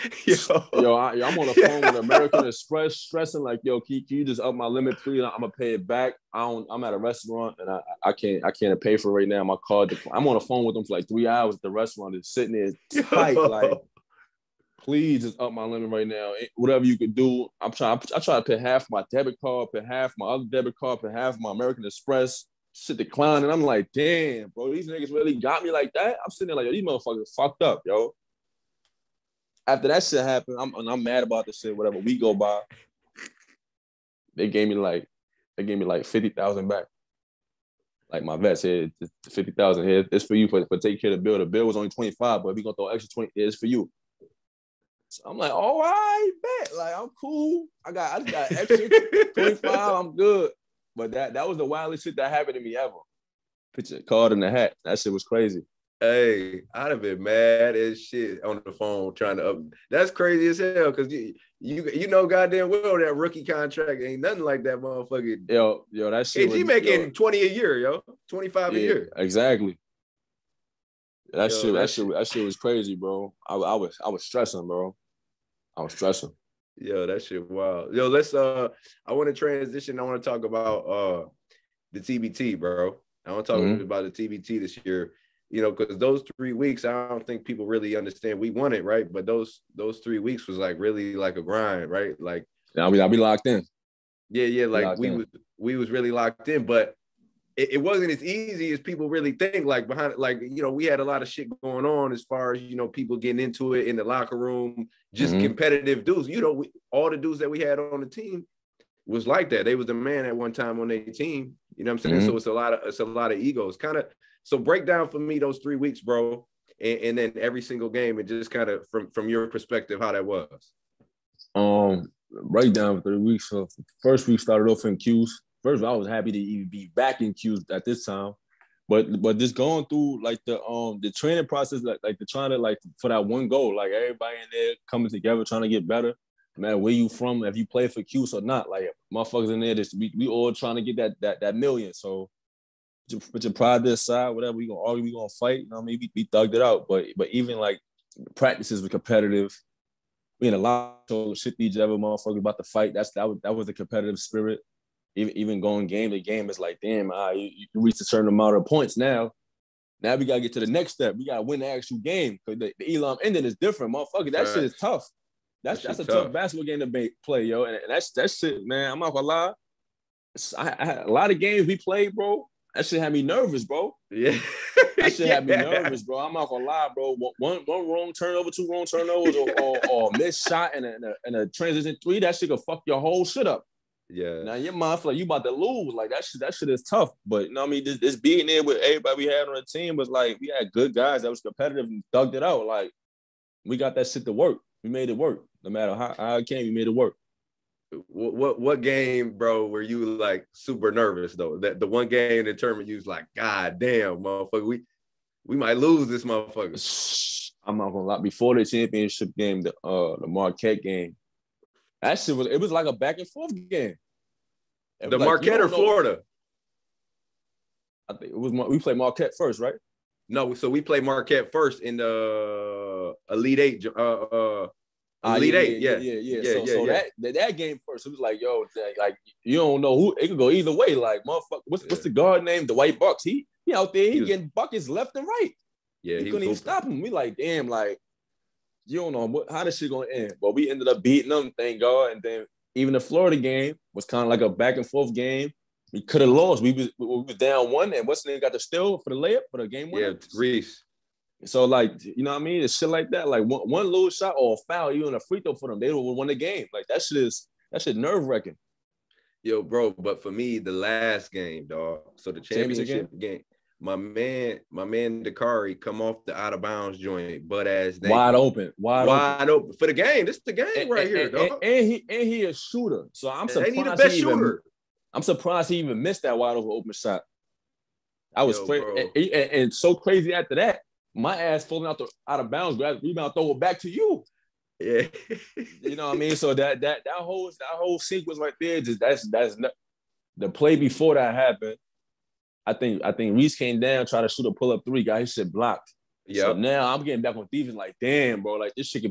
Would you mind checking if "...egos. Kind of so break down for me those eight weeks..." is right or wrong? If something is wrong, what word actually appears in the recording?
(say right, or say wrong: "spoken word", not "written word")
wrong: "three", not "eight".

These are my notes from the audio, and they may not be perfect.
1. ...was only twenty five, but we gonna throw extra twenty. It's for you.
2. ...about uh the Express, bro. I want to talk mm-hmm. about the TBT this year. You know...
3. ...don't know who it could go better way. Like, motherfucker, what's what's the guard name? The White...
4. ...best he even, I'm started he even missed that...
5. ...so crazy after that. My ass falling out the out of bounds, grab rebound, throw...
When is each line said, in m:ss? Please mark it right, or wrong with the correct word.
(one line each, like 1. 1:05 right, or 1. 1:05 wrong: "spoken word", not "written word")
1. 0:41 right
2. 1:20 wrong: "TBT", not "Express"
3. 3:49 wrong: "either", not "better"
4. 4:33 wrong: "surprised", not "started"
5. 4:39 right.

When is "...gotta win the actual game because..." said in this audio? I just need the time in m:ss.
2:41.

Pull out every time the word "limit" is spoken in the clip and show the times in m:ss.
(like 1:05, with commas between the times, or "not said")
0:04, 0:15.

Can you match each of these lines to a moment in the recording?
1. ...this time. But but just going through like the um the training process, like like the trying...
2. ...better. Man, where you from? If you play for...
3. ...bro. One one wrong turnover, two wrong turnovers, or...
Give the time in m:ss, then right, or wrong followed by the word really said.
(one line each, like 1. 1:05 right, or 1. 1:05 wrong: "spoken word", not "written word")
1. 2:07 right
2. 2:15 right
3. 2:56 right.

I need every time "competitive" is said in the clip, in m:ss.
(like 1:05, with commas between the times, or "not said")
1:45, 2:28, 2:33, 3:11.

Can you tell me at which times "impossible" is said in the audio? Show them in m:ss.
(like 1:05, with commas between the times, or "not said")
not said.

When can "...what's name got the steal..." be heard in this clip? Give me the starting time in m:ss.
4:08.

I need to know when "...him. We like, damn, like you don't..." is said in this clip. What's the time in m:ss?
3:56.